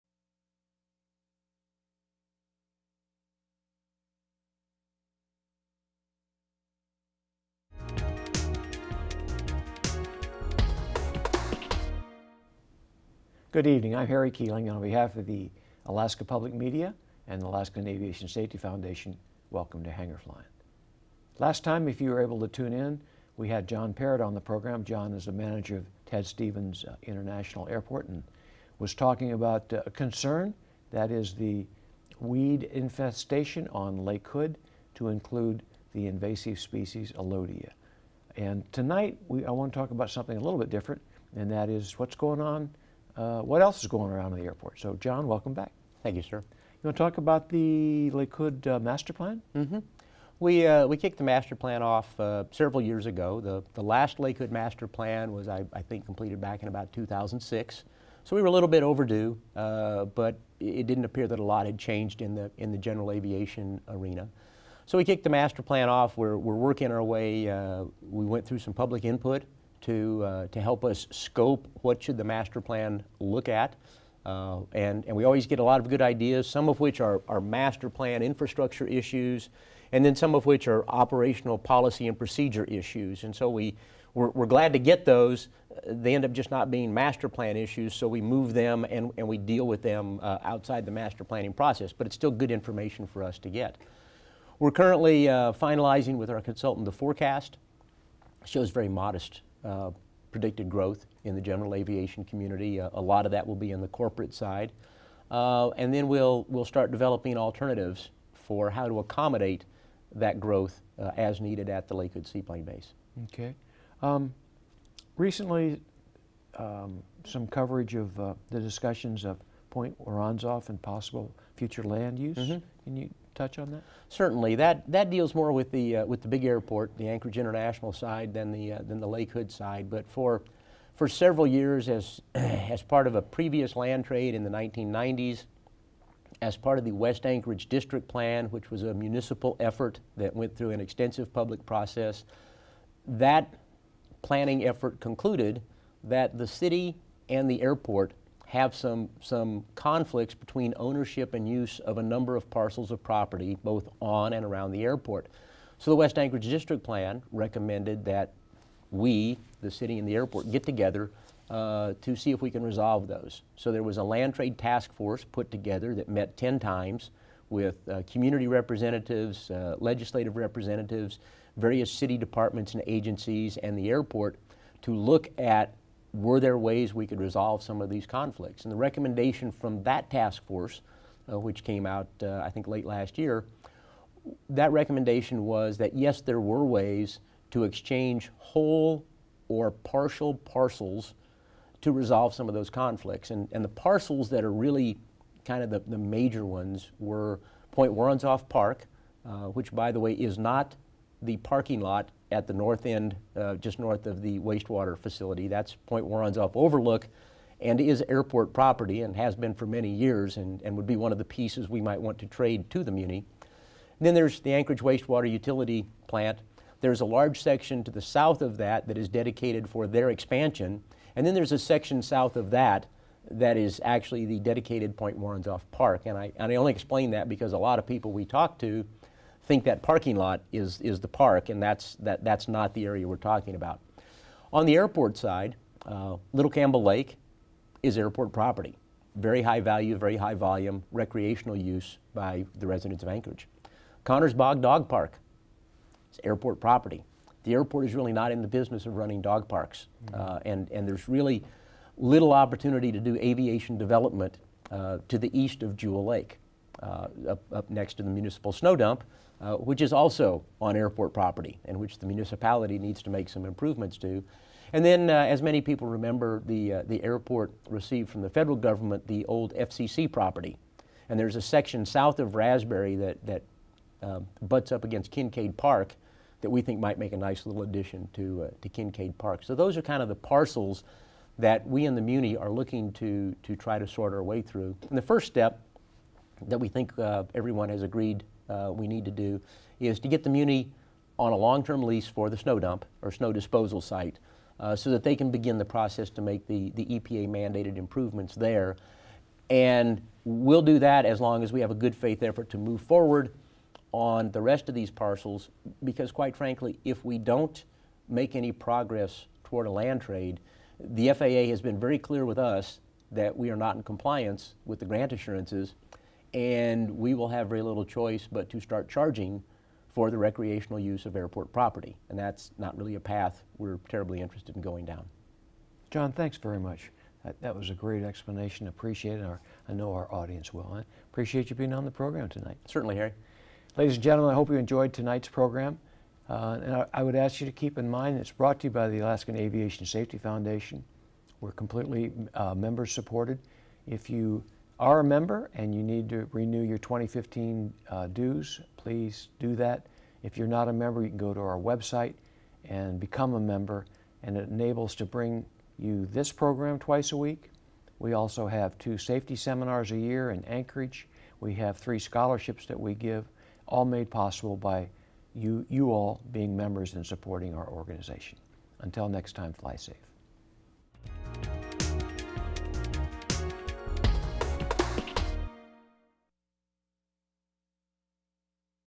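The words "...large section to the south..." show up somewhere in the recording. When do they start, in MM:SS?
03:37.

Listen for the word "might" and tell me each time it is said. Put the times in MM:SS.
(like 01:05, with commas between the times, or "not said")
03:31, 04:36.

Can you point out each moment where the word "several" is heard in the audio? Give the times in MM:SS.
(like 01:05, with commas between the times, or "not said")
00:52, 02:11.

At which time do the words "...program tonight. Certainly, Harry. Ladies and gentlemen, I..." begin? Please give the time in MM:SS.
05:31.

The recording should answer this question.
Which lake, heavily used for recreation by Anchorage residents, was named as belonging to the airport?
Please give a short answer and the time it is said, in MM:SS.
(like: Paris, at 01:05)
Little Campbell Lake, at 03:56.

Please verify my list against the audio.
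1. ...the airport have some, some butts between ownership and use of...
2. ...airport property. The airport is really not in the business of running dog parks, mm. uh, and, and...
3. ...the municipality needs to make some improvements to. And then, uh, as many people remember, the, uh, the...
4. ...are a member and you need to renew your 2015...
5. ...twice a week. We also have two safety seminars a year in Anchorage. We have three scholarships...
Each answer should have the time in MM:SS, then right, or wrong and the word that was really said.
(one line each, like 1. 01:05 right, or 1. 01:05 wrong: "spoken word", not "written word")
1. 02:27 wrong: "conflicts", not "butts"
2. 04:06 right
3. 04:21 right
4. 05:44 right
5. 05:56 right.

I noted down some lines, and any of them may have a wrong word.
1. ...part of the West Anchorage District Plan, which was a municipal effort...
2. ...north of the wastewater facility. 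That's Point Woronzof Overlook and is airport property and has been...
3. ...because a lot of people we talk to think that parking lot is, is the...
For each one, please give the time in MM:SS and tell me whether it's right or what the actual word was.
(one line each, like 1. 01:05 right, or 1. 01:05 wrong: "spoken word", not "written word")
1. 02:16 right
2. 03:23 right
3. 03:47 right.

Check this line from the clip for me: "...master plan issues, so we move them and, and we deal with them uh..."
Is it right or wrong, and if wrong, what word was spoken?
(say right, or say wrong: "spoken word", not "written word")
right.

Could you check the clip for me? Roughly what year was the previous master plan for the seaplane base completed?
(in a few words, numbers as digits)
2006.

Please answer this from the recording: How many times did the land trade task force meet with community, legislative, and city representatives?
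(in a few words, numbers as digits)
10.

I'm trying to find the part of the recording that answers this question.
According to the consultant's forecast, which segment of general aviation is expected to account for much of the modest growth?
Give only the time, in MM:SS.
01:43.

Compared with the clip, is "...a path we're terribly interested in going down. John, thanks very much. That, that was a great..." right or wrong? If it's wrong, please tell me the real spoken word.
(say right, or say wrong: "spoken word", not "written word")
right.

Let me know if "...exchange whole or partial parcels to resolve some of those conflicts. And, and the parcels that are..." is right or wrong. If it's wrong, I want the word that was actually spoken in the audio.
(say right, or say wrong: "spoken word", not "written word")
right.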